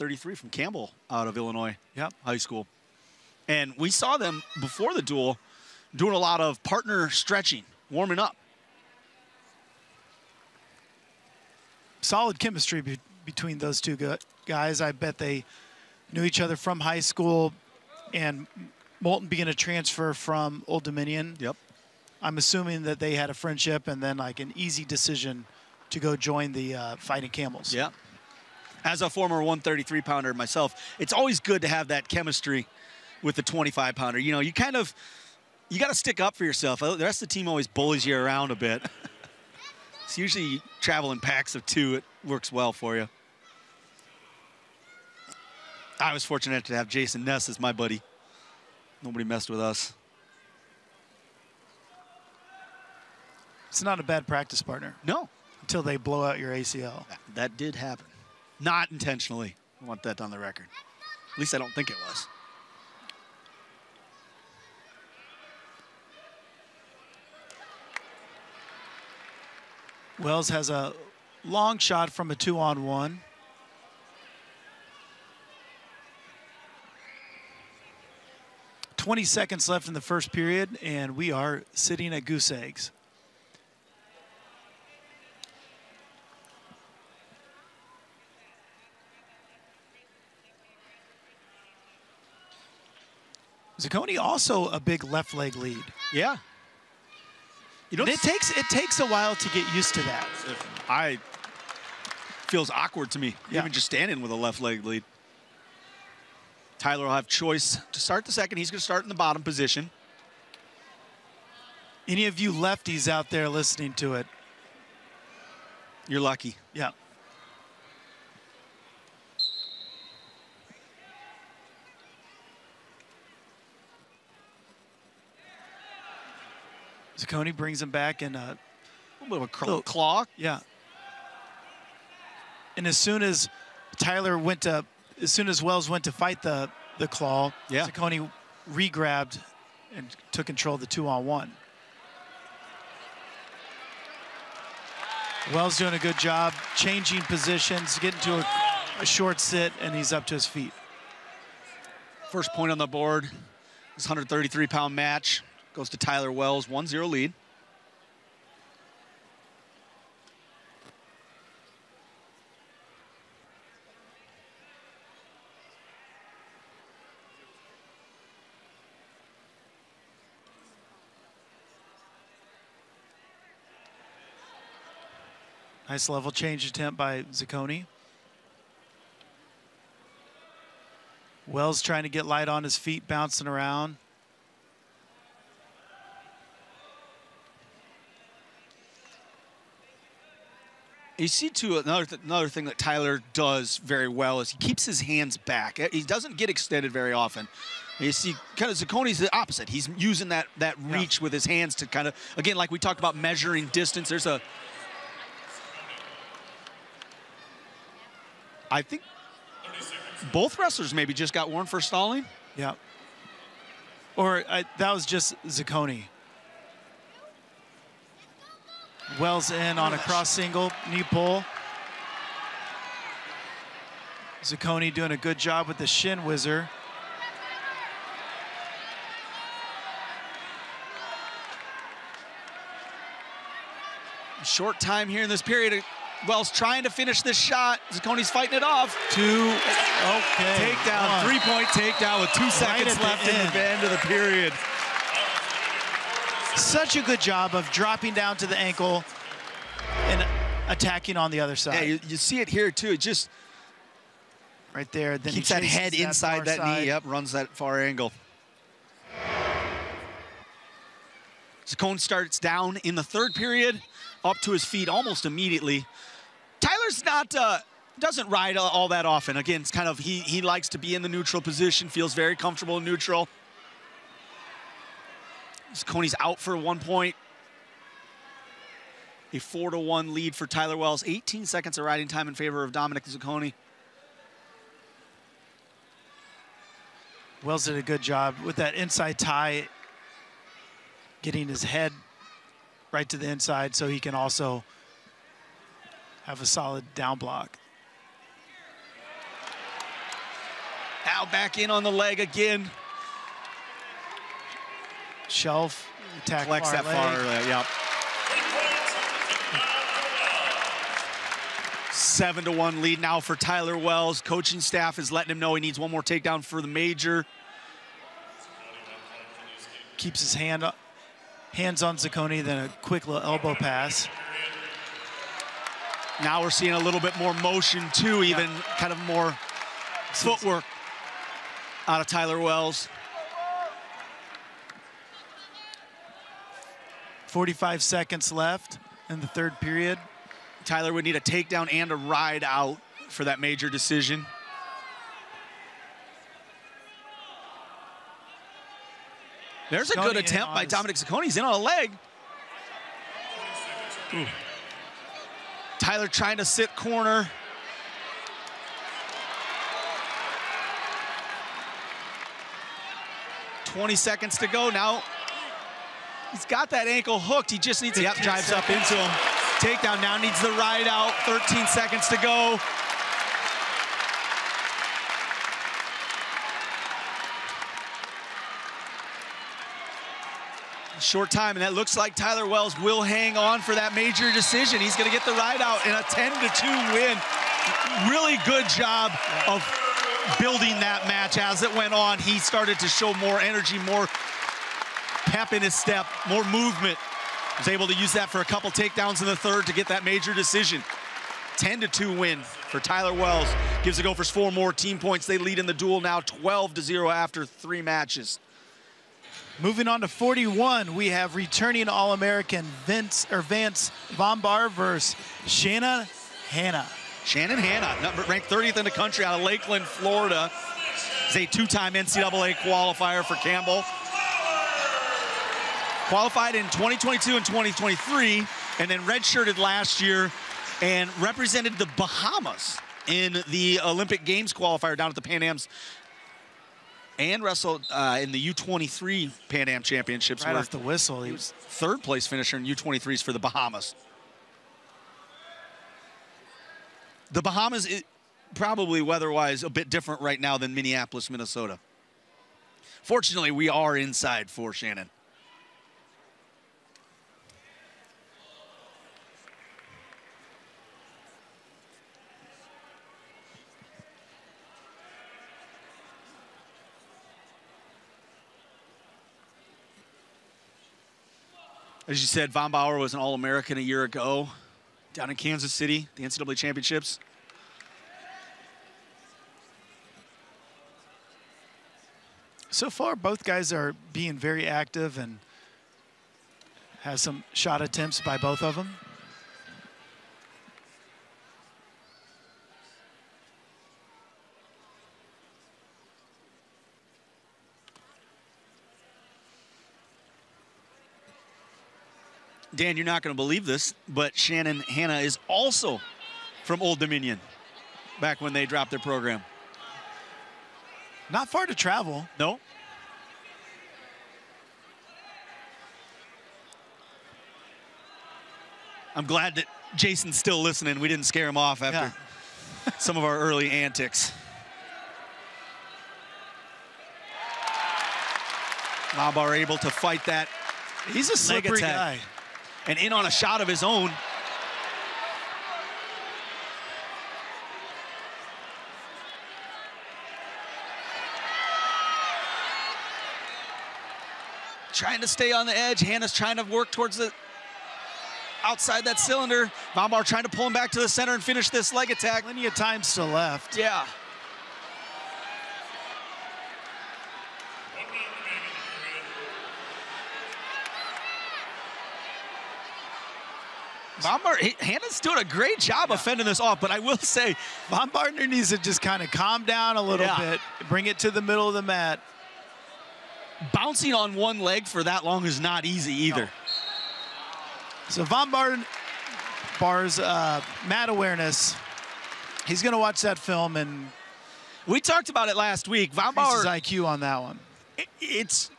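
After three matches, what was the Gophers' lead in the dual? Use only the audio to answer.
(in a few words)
12 to 0.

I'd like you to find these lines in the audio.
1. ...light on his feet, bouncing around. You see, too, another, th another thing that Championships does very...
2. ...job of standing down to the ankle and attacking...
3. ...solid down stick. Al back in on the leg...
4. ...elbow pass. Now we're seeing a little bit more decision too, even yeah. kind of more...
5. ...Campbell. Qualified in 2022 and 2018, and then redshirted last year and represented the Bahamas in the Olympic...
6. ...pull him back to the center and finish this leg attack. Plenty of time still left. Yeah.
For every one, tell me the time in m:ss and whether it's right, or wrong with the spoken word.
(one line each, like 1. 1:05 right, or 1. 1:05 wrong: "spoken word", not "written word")
1. 3:02 wrong: "Tyler", not "Championships"
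2. 4:07 wrong: "dropping", not "standing"
3. 4:56 wrong: "block", not "stick"
4. 5:23 wrong: "motion", not "decision"
5. 7:03 wrong: "2023", not "2018"
6. 9:10 right.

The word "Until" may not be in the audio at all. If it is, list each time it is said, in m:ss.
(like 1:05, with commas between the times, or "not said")
0:55.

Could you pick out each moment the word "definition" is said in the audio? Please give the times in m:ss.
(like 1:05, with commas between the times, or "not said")
not said.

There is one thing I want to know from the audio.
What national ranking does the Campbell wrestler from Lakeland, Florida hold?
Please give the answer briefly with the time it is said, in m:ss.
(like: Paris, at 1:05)
30th, at 6:58.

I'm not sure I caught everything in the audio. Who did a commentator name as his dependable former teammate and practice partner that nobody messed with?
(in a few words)
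Jason Ness.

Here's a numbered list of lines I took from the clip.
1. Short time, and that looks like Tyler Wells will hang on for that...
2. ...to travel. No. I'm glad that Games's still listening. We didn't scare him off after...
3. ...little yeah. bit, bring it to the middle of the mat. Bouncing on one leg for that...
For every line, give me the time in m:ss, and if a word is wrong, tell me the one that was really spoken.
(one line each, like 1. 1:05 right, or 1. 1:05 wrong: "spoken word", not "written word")
1. 6:20 right
2. 8:31 wrong: "Jason", not "Games"
3. 9:30 right.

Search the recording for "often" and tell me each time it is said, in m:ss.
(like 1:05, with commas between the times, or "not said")
3:17, 4:29.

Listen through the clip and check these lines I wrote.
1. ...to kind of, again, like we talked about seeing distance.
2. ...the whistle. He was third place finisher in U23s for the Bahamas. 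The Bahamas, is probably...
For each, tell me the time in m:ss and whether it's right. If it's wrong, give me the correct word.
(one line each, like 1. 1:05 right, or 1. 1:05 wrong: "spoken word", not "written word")
1. 3:21 wrong: "measuring", not "seeing"
2. 7:20 right.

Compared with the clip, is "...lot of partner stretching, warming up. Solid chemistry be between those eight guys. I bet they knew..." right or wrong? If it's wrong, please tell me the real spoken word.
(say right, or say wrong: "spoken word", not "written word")
wrong: "two", not "eight".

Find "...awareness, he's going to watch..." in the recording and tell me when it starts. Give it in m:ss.
9:41.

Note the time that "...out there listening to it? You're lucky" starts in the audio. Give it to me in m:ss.
1:53.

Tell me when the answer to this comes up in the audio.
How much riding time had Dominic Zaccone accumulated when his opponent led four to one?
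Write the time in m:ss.
4:41.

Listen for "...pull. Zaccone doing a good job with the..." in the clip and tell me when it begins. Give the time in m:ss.
3:41.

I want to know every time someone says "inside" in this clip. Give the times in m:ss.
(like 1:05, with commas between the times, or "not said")
4:15, 4:48, 4:53, 7:33.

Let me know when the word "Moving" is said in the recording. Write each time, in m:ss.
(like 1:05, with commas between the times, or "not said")
6:49.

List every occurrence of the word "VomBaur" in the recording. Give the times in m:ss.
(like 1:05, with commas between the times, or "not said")
6:54, 7:52, 9:09, 9:46.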